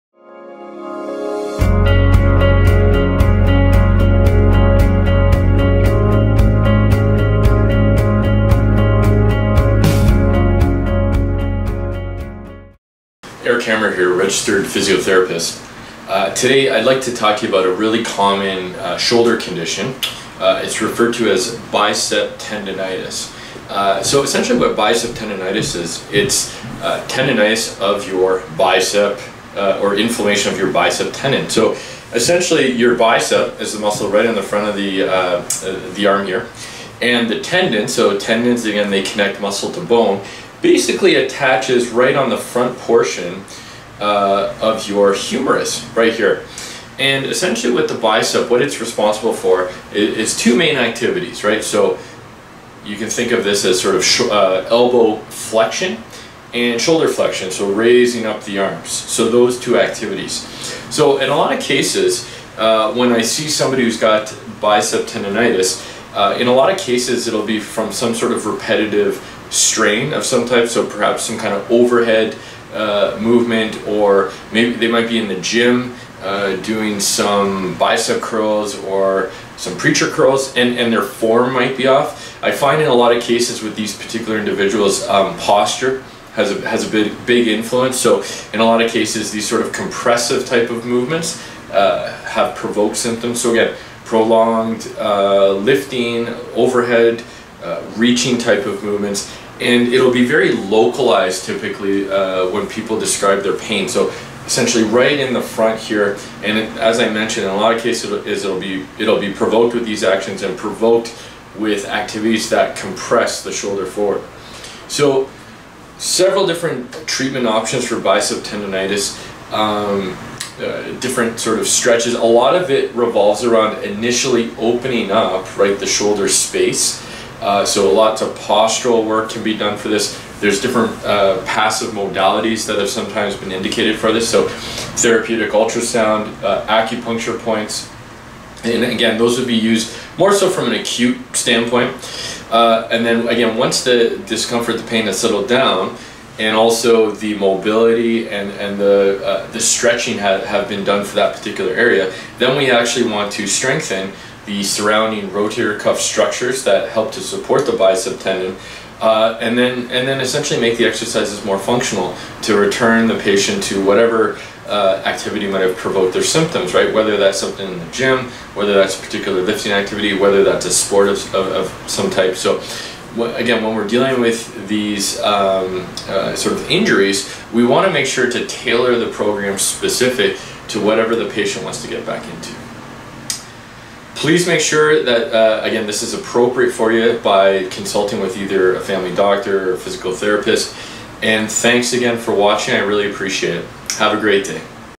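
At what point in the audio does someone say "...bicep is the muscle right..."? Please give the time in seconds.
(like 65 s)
32 s.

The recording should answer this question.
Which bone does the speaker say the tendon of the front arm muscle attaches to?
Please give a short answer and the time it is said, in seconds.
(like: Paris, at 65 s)
humerus, at 45 s.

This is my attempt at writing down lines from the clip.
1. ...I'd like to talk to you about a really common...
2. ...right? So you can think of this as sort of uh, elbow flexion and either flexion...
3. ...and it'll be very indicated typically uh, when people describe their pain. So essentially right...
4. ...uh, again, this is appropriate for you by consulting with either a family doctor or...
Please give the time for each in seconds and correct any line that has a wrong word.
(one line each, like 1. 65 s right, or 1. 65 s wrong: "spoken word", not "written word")
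1. 16 s right
2. 51 s wrong: "shoulder", not "either"
3. 99 s wrong: "localized", not "indicated"
4. 185 s right.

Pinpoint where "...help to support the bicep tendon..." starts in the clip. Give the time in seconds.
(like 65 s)
156 s.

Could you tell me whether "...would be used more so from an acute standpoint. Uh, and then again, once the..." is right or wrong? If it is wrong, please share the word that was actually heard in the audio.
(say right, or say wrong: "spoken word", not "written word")
right.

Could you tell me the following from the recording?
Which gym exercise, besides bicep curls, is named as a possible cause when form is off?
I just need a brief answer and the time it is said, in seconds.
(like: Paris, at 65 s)
preacher curls, at 79 s.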